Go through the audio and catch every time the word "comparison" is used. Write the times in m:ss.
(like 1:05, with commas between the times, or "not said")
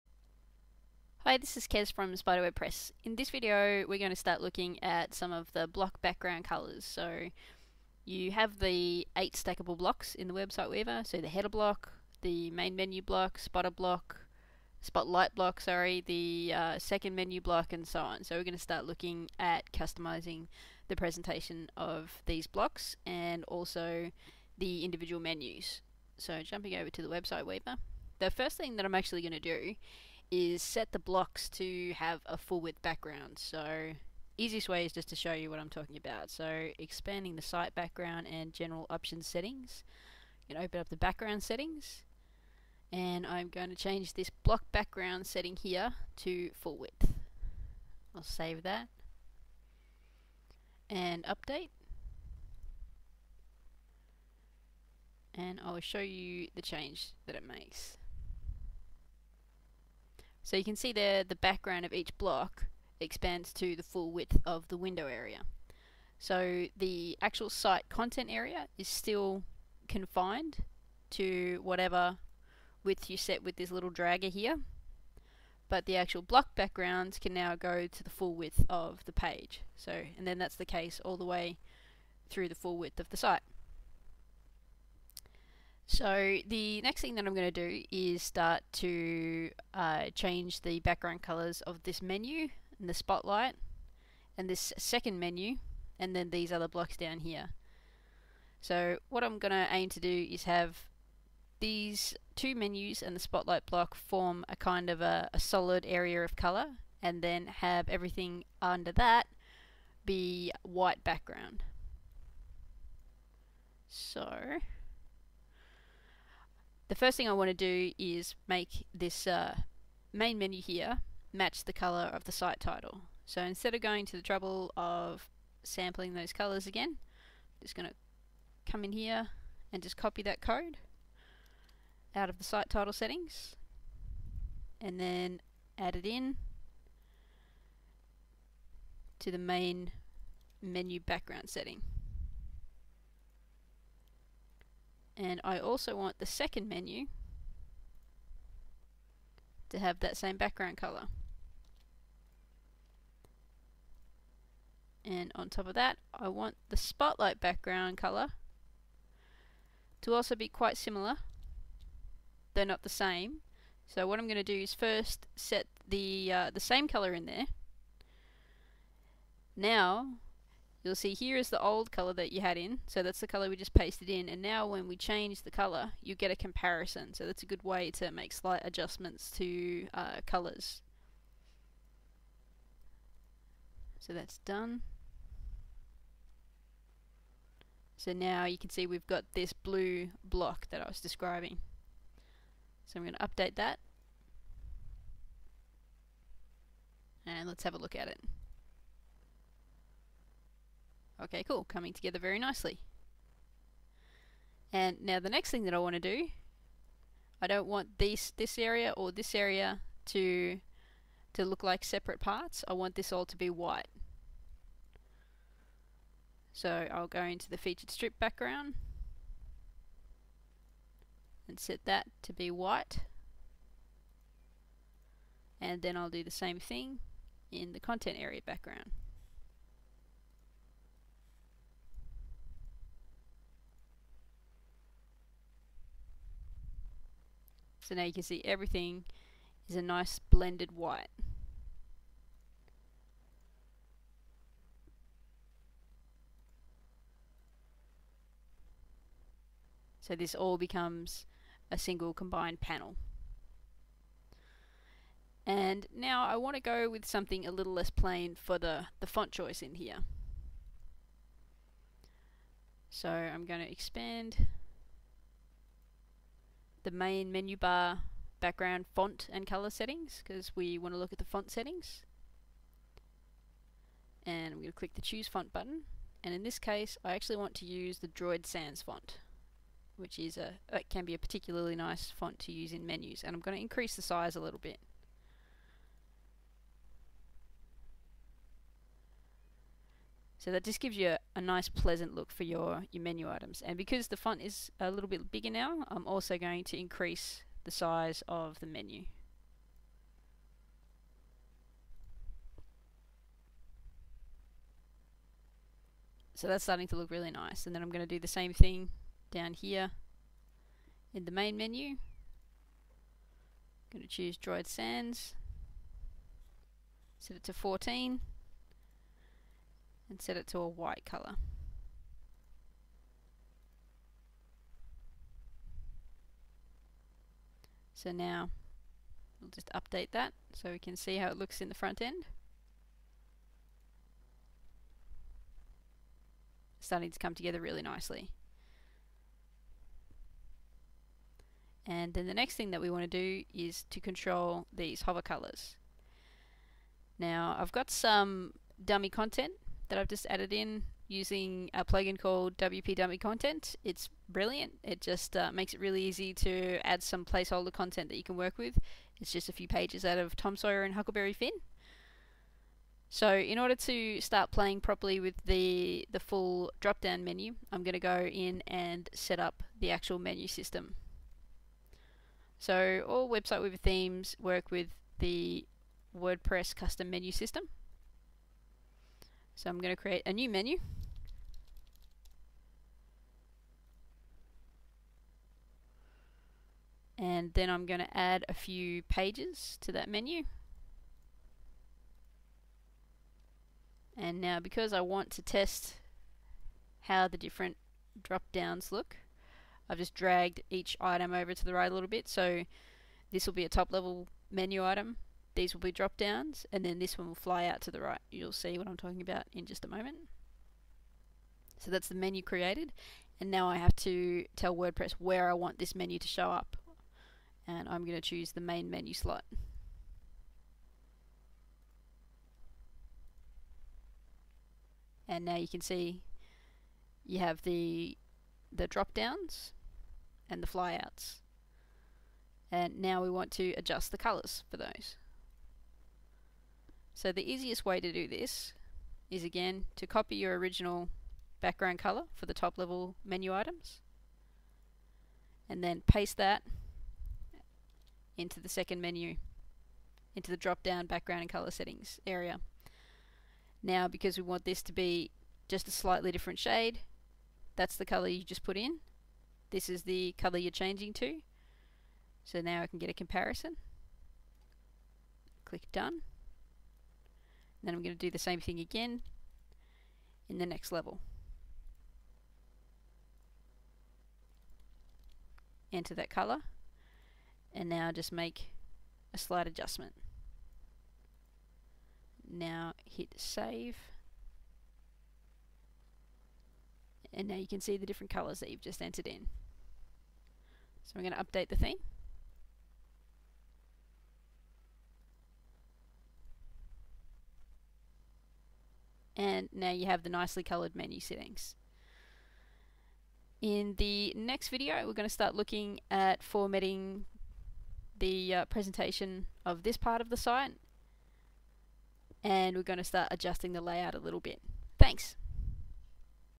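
2:56, 7:43.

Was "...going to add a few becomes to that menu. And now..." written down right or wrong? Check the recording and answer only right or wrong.
wrong.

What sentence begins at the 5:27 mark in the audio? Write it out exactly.
So now we'll just update that so we can see how it looks in the front end.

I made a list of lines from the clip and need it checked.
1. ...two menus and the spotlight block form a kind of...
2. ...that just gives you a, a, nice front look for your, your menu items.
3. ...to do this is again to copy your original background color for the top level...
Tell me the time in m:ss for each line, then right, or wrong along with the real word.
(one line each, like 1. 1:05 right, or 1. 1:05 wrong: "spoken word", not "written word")
1. 1:42 right
2. 4:50 wrong: "pleasant", not "front"
3. 7:17 right.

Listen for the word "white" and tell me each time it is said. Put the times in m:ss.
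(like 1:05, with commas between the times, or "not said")
1:50, 3:33, 3:42, 4:00, 5:20.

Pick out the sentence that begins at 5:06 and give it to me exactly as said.
So that's starting to look really nice.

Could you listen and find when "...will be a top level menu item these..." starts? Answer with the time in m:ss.
6:43.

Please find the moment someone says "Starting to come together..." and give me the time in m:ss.
5:36.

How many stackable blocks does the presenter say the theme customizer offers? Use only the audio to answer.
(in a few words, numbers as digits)
8.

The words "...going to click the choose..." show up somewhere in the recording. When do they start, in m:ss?
4:34.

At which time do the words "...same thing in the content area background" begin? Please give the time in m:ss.
3:46.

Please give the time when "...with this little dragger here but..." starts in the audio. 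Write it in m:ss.
1:13.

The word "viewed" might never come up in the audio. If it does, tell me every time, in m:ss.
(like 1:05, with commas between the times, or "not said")
not said.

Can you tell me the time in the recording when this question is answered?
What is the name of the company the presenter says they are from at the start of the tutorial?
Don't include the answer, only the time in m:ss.
0:02.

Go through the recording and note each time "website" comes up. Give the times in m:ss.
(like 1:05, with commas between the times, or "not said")
0:10, 0:27, 6:13.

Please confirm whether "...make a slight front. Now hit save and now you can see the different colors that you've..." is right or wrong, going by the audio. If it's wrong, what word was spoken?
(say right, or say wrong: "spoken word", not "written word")
wrong: "adjustment", not "front".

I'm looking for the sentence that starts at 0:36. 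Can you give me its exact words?
So expanding the site background and general options settings.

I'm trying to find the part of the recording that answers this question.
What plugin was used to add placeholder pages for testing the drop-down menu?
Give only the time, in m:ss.
5:52.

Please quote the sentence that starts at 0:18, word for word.
So we're going to start looking at customizing the presentation of these blocks and also the individual menus.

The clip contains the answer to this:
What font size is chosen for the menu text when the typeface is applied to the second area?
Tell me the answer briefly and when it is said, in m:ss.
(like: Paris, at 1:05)
14, at 5:17.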